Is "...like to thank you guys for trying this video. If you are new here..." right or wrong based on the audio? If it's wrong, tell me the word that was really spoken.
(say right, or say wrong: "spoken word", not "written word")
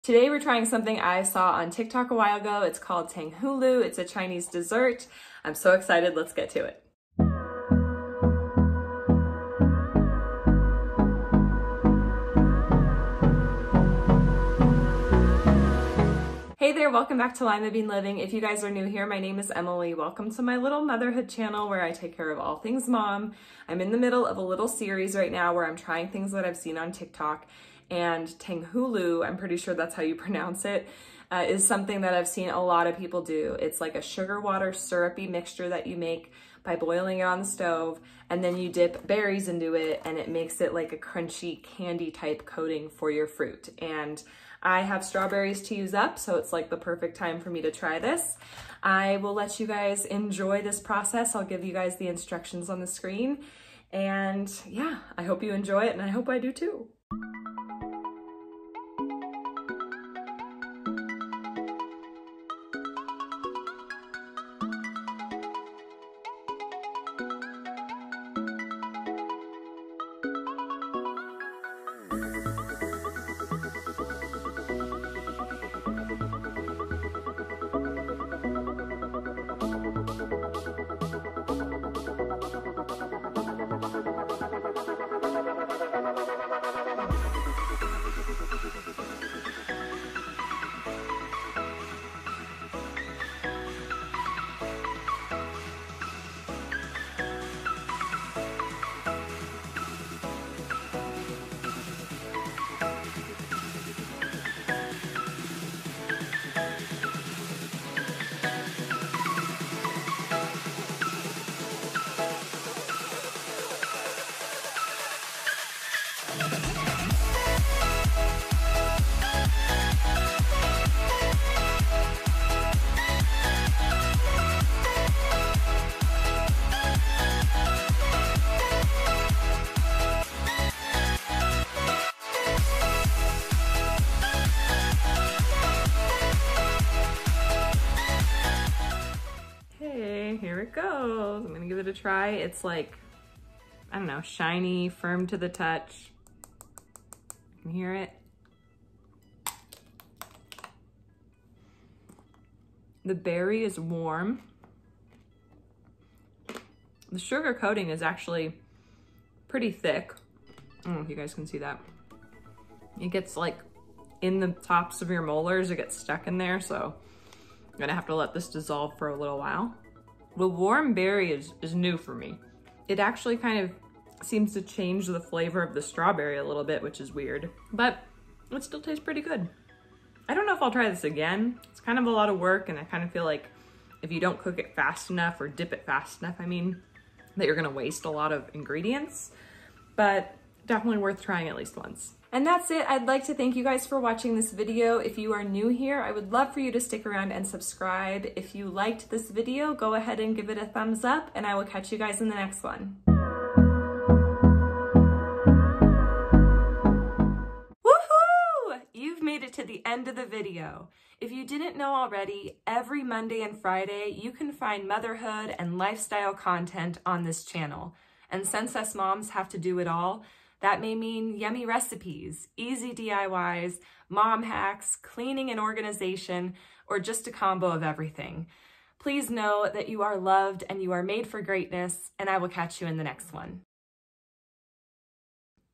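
wrong: "watching", not "trying".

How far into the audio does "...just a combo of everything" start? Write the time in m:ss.
3:46.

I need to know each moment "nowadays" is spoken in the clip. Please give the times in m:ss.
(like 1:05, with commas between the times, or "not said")
not said.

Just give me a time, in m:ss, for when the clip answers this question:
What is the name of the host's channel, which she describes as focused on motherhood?
0:17.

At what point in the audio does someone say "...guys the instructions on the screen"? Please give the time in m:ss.
0:51.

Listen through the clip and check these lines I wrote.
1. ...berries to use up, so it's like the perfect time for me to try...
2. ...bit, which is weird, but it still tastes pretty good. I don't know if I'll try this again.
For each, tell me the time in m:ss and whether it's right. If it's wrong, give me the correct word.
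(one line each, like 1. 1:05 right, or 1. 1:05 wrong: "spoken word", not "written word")
1. 0:45 wrong: "strawberries", not "berries"
2. 2:56 right.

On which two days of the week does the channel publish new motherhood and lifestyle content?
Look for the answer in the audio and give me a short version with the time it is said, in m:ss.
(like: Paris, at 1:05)
Monday and Friday, at 3:33.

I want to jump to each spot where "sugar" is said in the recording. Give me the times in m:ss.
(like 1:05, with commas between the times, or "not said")
0:34, 2:37.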